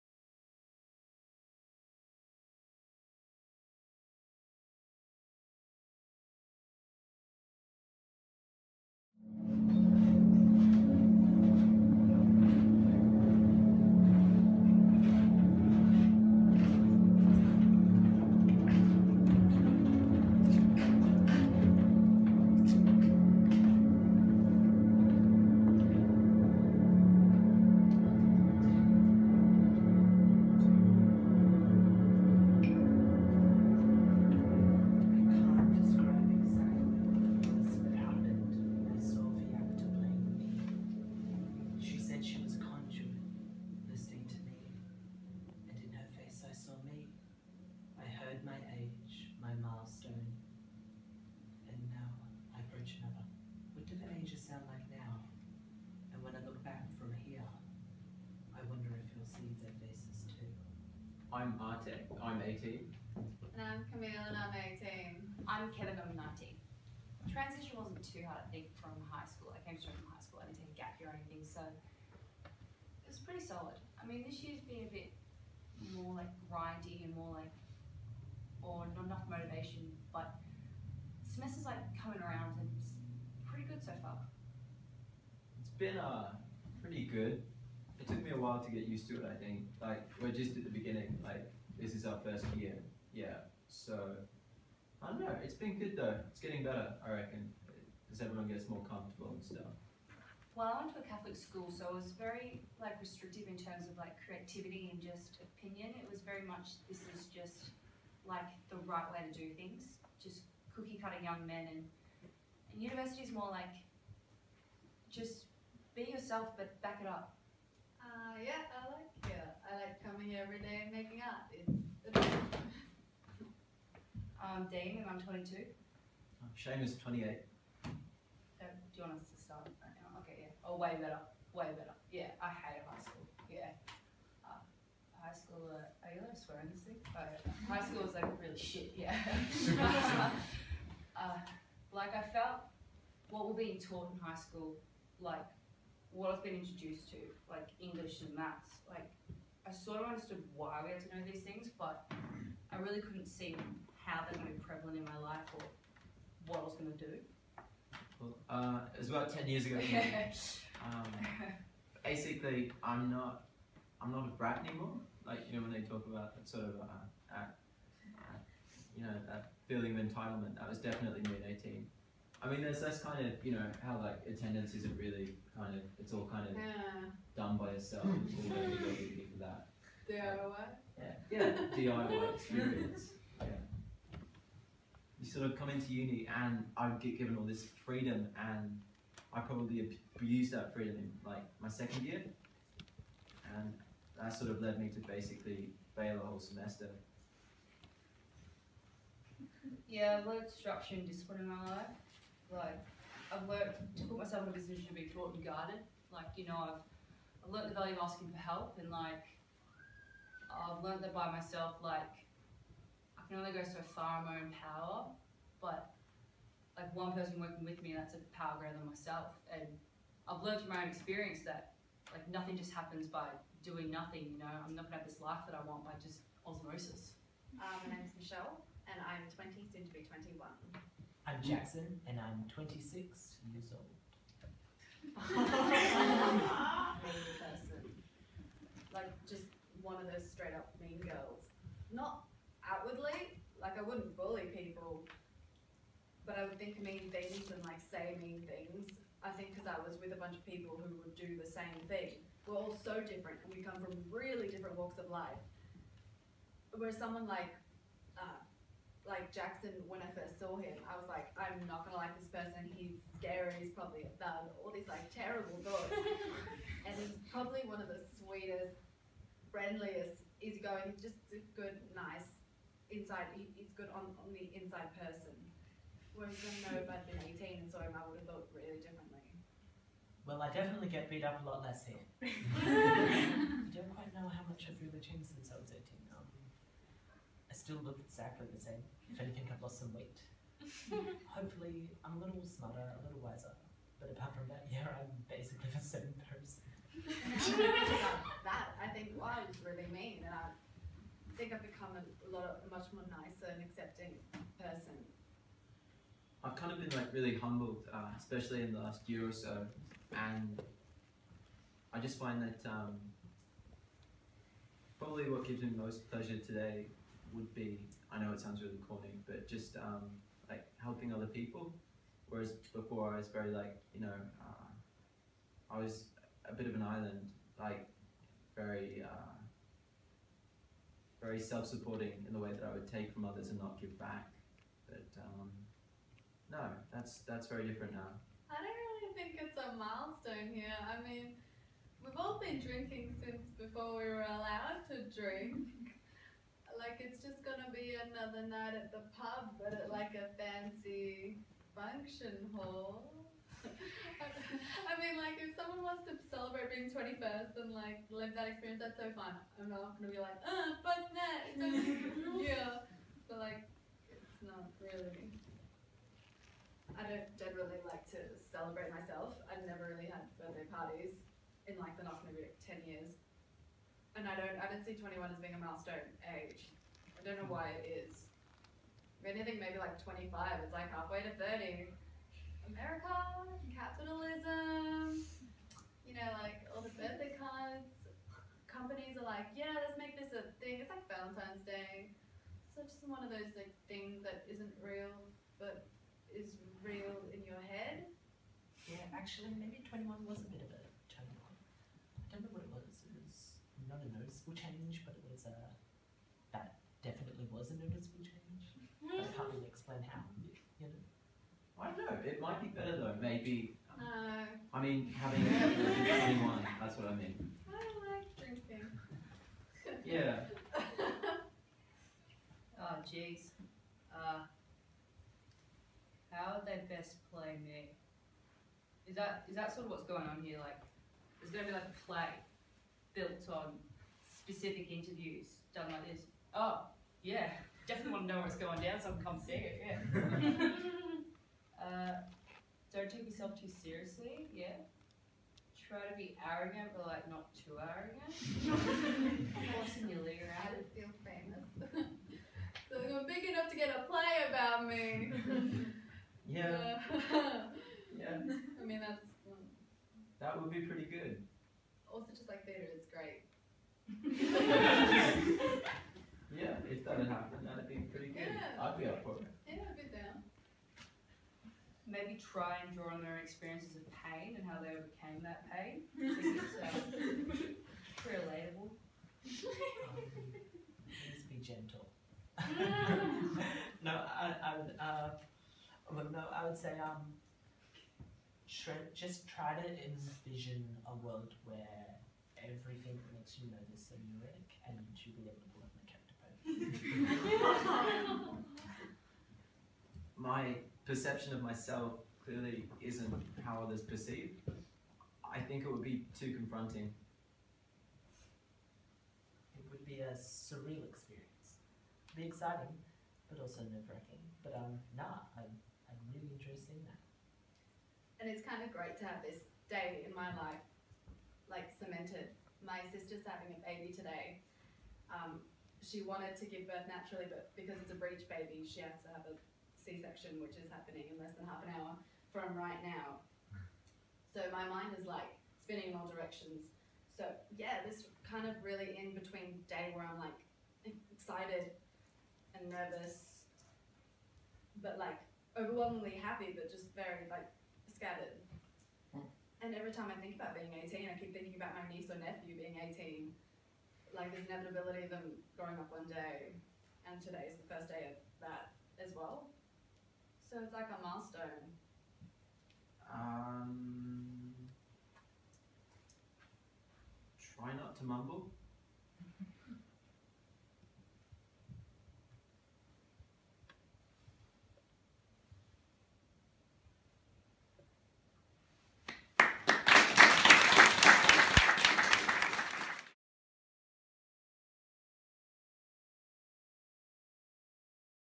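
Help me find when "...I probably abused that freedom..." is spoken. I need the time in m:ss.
3:09.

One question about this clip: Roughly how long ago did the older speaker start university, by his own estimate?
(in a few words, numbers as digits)
10 years ago.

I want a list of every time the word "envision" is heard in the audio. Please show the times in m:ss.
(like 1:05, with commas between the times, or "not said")
8:10.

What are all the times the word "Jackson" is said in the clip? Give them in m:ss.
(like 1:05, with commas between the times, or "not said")
3:51, 4:19.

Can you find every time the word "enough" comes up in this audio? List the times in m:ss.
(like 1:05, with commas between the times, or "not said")
1:19, 7:33.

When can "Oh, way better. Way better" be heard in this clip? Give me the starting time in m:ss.
2:10.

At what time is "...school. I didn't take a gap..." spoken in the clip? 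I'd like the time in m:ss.
1:10.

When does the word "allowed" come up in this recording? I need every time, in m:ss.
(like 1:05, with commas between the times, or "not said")
2:16, 5:44.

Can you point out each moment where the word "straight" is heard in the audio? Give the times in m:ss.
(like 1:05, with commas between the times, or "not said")
1:09, 4:00.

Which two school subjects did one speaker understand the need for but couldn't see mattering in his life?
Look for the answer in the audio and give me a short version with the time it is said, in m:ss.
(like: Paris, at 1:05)
English and maths, at 2:27.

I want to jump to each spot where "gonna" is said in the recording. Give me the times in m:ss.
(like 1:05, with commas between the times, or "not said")
3:44, 4:21, 5:47.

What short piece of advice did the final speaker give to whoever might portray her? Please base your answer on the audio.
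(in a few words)
Try not to mumble.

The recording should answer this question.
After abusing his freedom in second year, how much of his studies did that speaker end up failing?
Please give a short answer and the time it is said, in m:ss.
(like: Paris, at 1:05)
A whole semester, at 3:16.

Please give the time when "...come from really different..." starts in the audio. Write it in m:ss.
4:13.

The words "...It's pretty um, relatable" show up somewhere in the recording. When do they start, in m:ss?
7:58.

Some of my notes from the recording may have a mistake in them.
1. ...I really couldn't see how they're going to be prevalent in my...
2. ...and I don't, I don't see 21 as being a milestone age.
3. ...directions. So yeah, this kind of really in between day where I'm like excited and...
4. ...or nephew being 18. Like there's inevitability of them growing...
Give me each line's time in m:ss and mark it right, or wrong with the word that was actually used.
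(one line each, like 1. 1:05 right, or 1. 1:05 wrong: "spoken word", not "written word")
1. 2:32 right
2. 6:14 right
3. 8:56 right
4. 9:12 right.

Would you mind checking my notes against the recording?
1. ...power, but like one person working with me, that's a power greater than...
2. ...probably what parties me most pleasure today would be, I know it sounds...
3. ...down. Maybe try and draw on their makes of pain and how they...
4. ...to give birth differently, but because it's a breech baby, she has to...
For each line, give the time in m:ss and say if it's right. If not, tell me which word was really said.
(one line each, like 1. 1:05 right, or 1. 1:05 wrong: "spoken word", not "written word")
1. 3:34 right
2. 5:14 wrong: "gives", not "parties"
3. 7:50 wrong: "experiences", not "makes"
4. 8:46 wrong: "naturally", not "differently".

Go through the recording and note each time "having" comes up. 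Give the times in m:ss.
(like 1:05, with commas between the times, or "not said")
6:55, 8:43.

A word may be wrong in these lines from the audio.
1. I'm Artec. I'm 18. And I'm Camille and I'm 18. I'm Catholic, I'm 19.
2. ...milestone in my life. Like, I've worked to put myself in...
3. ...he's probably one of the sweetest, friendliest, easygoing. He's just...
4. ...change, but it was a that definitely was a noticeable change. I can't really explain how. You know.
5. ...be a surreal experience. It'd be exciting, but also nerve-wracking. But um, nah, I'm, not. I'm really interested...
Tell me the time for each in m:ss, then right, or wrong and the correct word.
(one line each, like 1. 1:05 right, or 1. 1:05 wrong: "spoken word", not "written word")
1. 1:01 wrong: "Kevin", not "Catholic"
2. 3:21 wrong: "discipline", not "milestone"
3. 4:27 right
4. 6:44 right
5. 8:30 right.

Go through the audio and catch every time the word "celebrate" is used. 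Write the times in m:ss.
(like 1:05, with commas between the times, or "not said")
5:56, 6:08.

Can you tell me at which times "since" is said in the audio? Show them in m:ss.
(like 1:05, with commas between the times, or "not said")
4:45, 5:43.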